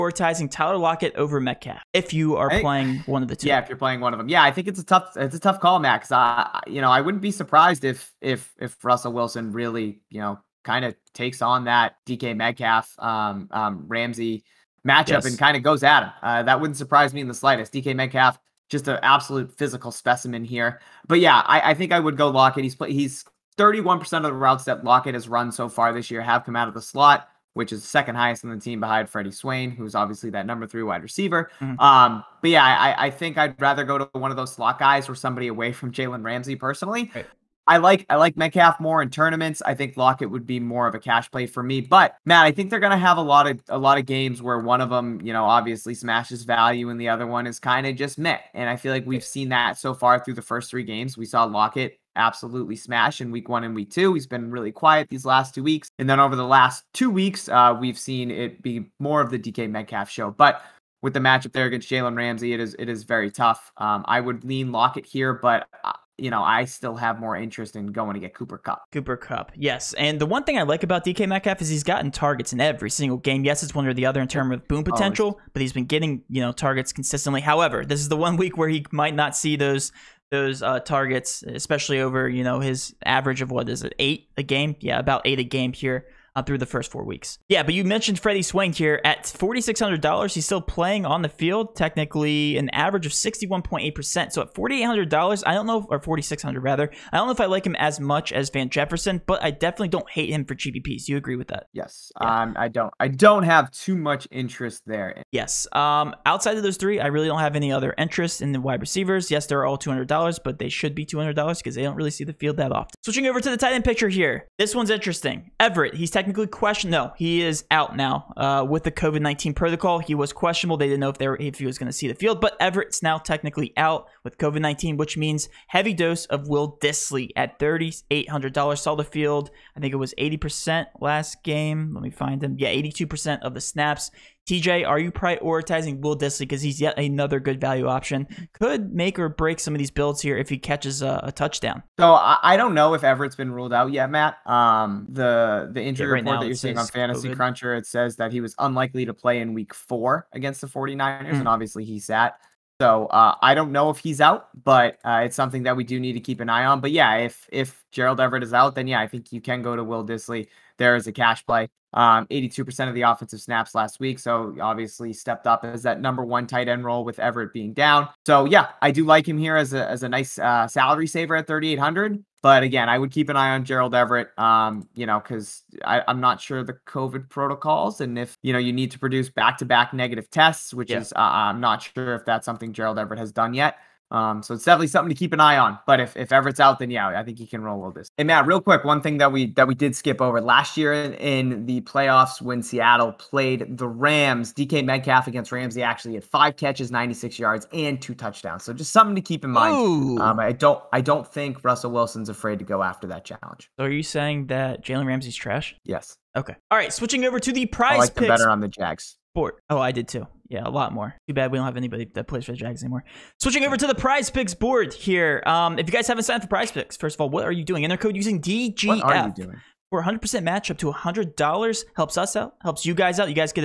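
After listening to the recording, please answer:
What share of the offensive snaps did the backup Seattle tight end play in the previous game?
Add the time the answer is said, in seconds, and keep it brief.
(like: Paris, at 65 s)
82%, at 132 s.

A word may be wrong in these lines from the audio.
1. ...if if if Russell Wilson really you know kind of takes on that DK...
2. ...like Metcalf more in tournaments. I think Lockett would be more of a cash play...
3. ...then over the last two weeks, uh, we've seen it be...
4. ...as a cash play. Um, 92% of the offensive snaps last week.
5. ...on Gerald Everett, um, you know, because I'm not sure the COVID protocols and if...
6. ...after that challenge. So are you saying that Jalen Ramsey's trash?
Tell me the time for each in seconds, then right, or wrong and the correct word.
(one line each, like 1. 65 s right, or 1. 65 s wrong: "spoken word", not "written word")
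1. 7 s right
2. 38 s right
3. 56 s right
4. 160 s wrong: "82", not "92"
5. 173 s right
6. 202 s right.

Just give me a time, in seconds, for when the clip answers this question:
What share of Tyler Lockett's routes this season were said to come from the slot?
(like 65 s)
23 s.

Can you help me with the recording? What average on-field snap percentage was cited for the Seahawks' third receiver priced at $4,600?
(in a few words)
61.8%.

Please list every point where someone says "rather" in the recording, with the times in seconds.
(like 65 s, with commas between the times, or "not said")
33 s, 96 s.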